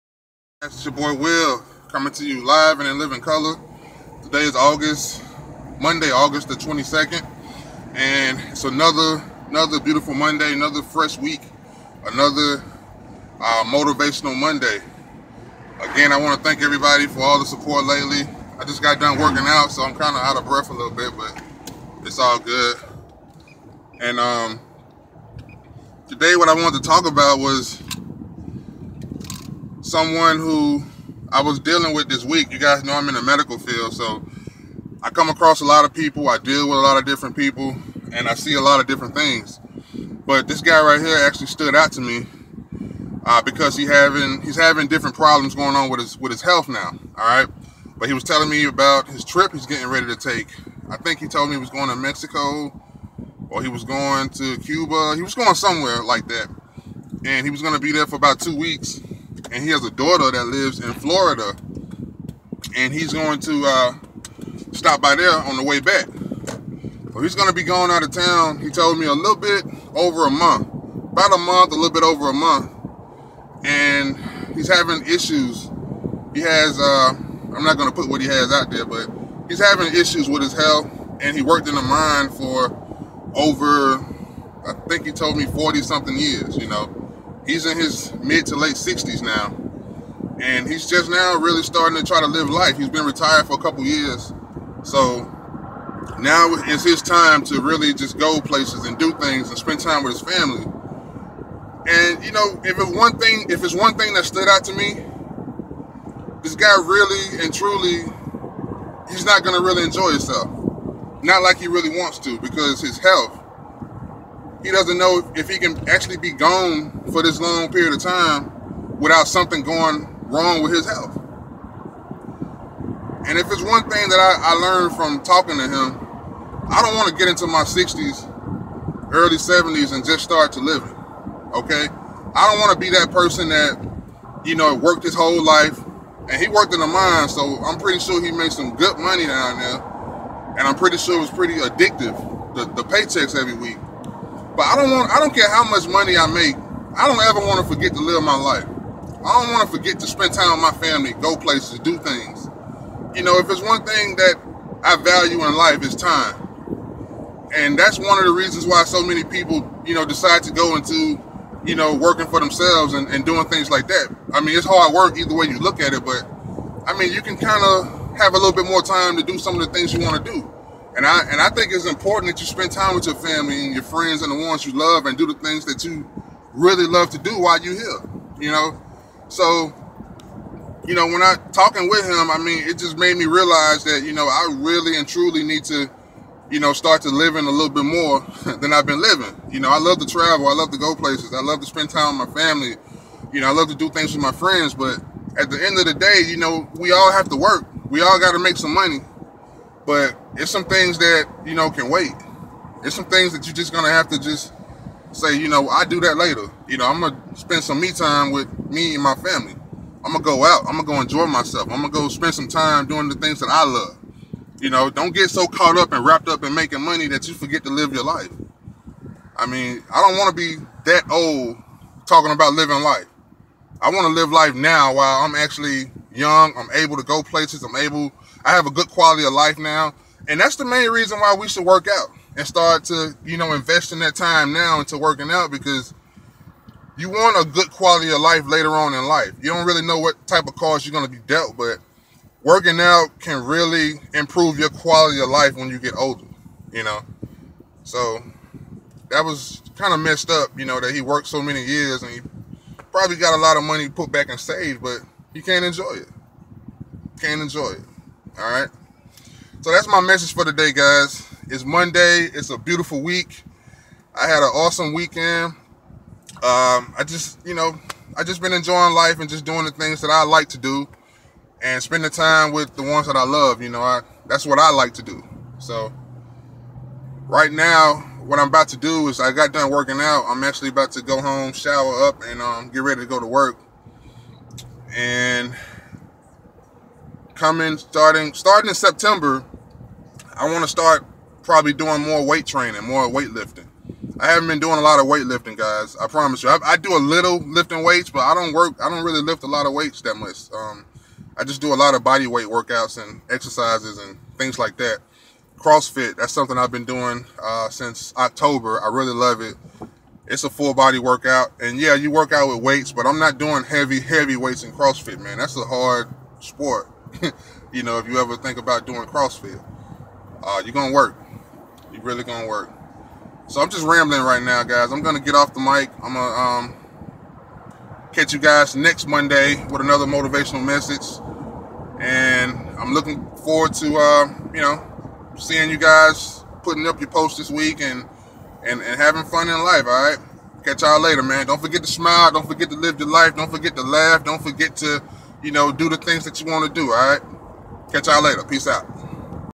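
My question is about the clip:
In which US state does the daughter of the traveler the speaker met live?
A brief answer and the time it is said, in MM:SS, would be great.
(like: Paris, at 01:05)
Florida, at 01:00.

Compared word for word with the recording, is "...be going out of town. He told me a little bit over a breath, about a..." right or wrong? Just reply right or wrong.
wrong.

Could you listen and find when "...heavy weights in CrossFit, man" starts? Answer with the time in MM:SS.
05:13.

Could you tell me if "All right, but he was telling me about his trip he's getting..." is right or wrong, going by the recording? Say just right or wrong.
right.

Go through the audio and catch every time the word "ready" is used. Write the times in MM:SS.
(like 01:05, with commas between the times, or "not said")
00:49, 04:42.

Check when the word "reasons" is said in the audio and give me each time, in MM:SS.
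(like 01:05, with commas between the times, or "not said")
02:38, 03:50.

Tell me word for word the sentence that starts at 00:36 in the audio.
I deal with a lot of different people, and I see a lot of different things.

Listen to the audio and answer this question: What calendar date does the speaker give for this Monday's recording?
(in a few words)
August 22.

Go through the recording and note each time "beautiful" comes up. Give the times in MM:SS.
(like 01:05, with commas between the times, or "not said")
00:09, 04:22.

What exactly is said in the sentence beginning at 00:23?
And um, today what I wanted to talk about was someone who I was dealing with this week.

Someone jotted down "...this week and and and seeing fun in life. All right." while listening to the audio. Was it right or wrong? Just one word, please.
wrong.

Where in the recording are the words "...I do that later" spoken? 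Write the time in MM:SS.
03:25.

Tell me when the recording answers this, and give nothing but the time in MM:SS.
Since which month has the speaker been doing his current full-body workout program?
05:08.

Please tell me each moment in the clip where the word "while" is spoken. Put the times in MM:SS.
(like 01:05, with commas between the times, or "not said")
02:57, 03:44.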